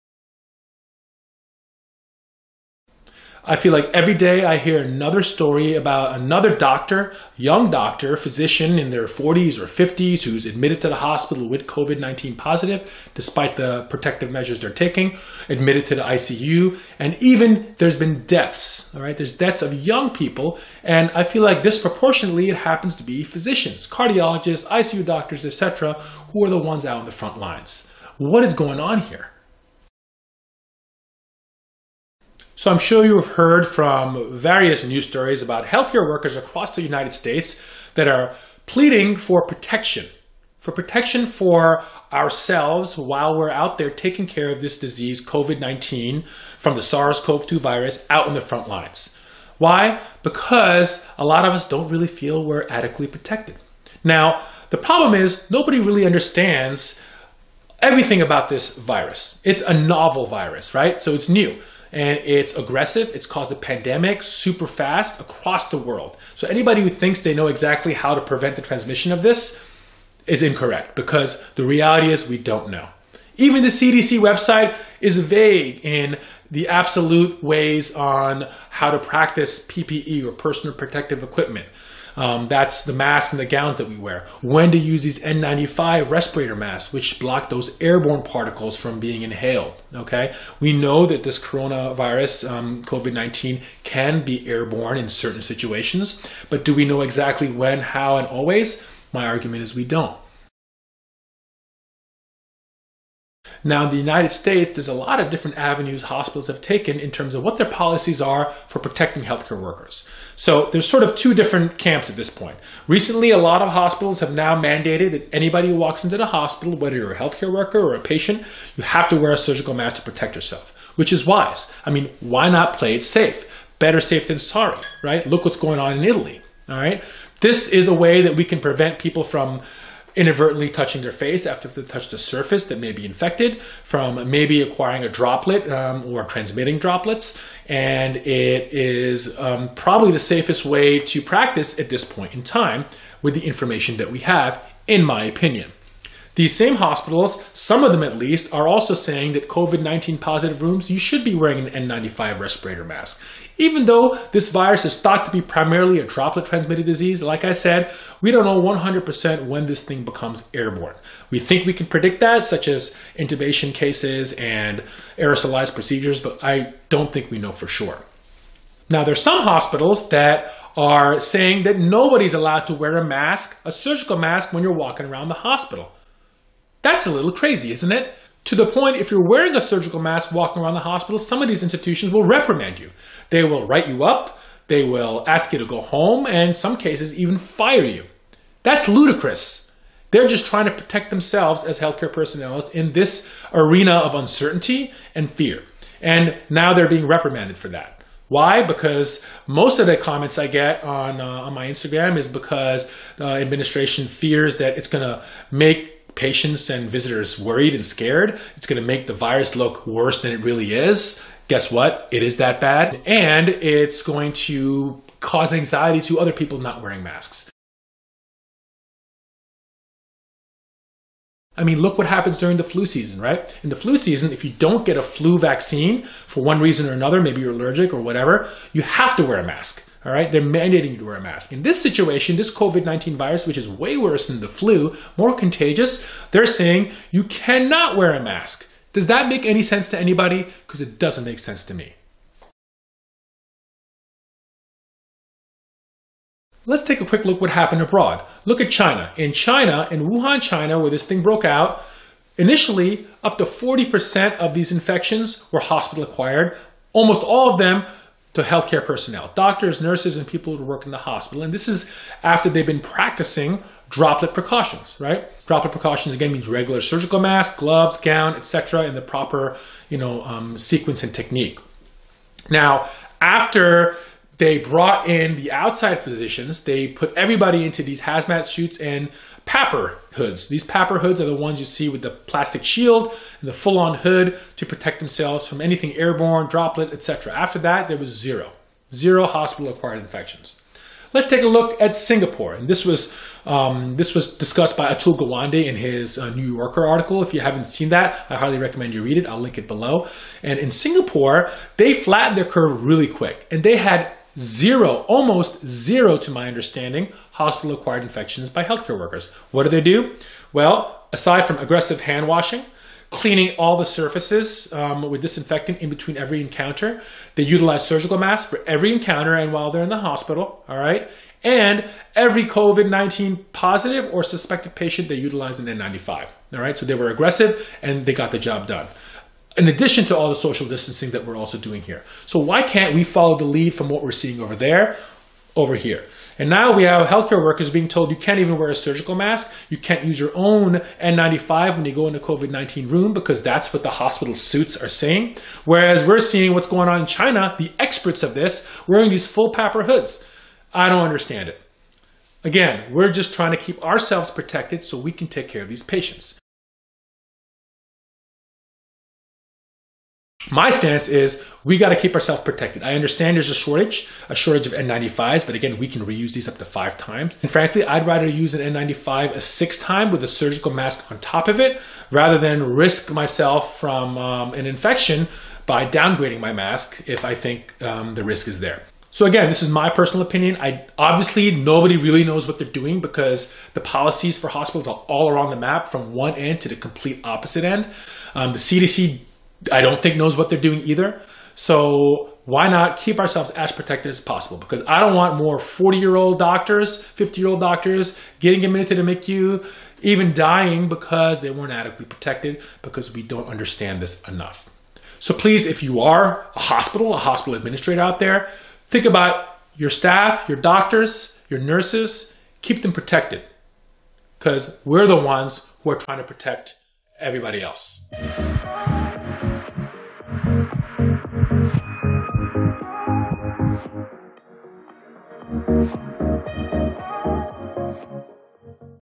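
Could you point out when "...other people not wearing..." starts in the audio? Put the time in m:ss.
3:36.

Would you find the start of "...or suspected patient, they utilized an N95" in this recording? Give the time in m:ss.
5:24.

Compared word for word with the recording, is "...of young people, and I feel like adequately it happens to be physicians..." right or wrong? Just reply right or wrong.
wrong.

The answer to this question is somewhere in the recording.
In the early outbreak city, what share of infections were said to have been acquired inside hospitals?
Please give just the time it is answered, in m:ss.
4:13.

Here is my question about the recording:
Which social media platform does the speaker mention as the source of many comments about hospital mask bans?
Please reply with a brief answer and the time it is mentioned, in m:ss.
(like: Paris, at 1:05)
Instagram, at 3:21.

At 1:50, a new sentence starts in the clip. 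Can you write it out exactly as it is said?
So there's sort of two different camps at this point.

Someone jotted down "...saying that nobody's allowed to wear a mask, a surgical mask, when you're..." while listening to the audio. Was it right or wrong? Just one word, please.
right.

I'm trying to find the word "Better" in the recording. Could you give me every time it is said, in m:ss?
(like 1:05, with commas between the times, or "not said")
2:03.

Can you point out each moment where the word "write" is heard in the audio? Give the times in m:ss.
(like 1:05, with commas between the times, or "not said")
3:03.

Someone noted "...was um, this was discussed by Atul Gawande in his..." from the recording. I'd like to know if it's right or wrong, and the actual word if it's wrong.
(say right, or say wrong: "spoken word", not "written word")
right.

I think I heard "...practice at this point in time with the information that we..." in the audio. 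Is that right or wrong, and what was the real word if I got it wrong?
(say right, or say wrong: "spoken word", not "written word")
right.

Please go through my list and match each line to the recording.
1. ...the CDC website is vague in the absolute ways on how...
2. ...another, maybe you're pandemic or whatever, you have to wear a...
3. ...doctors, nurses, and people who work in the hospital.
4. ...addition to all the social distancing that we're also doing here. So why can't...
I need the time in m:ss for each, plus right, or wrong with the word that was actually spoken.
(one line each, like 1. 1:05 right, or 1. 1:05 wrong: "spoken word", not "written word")
1. 1:13 right
2. 3:46 wrong: "allergic", not "pandemic"
3. 4:19 right
4. 5:29 right.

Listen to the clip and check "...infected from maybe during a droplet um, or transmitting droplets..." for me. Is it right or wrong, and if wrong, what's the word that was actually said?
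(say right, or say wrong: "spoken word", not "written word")
wrong: "acquiring", not "during".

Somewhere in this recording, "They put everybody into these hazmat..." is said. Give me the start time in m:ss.
4:36.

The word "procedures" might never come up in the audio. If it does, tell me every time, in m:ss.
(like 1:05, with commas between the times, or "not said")
2:45.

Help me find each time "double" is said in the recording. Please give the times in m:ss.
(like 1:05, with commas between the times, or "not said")
not said.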